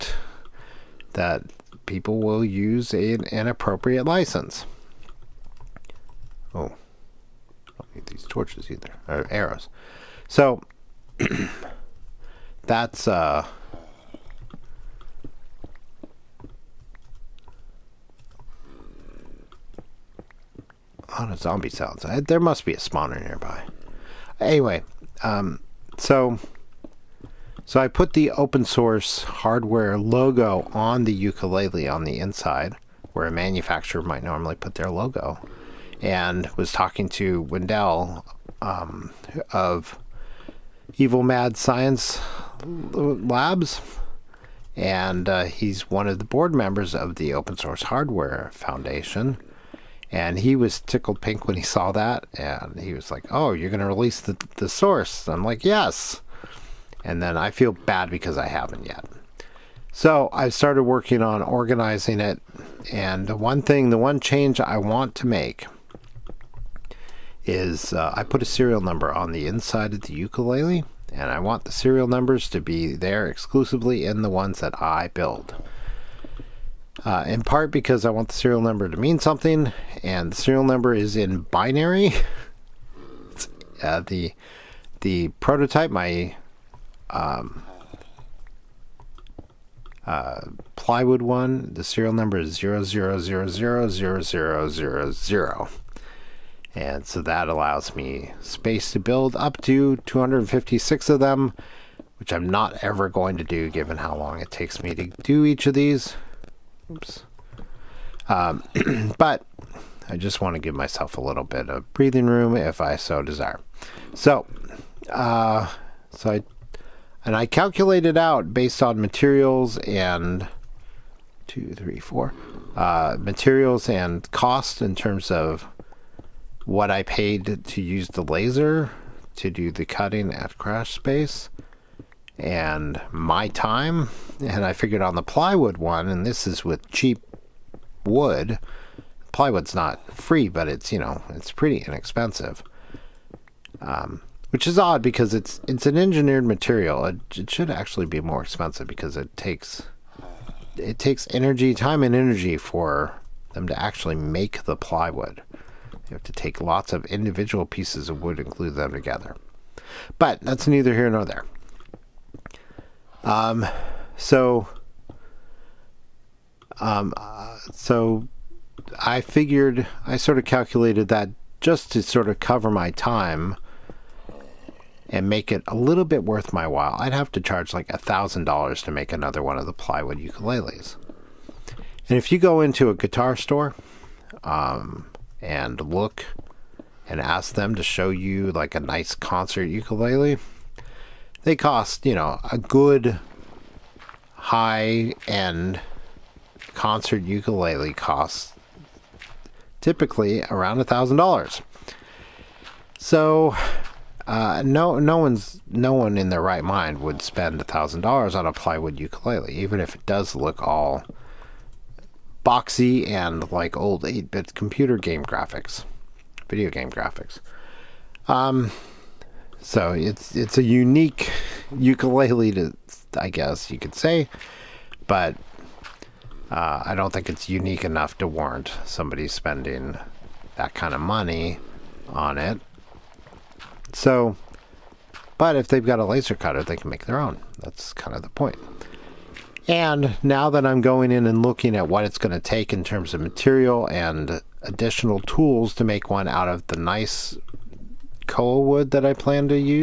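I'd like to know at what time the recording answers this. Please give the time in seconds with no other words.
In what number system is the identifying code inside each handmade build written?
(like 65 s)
81 s.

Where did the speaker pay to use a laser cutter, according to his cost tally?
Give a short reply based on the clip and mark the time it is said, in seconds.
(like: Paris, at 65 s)
Crash Space, at 130 s.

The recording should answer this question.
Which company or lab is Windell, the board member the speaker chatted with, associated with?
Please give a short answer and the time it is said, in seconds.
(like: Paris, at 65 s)
Evil Mad Science Labs, at 40 s.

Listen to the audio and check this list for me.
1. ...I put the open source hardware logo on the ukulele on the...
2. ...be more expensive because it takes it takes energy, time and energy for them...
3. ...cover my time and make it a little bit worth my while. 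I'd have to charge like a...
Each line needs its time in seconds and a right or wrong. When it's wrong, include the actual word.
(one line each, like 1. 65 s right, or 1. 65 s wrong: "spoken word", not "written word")
1. 27 s right
2. 148 s right
3. 172 s right.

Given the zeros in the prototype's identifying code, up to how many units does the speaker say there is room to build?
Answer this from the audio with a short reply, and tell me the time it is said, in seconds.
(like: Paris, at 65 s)
256, at 99 s.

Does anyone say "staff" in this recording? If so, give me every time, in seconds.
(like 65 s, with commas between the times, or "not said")
not said.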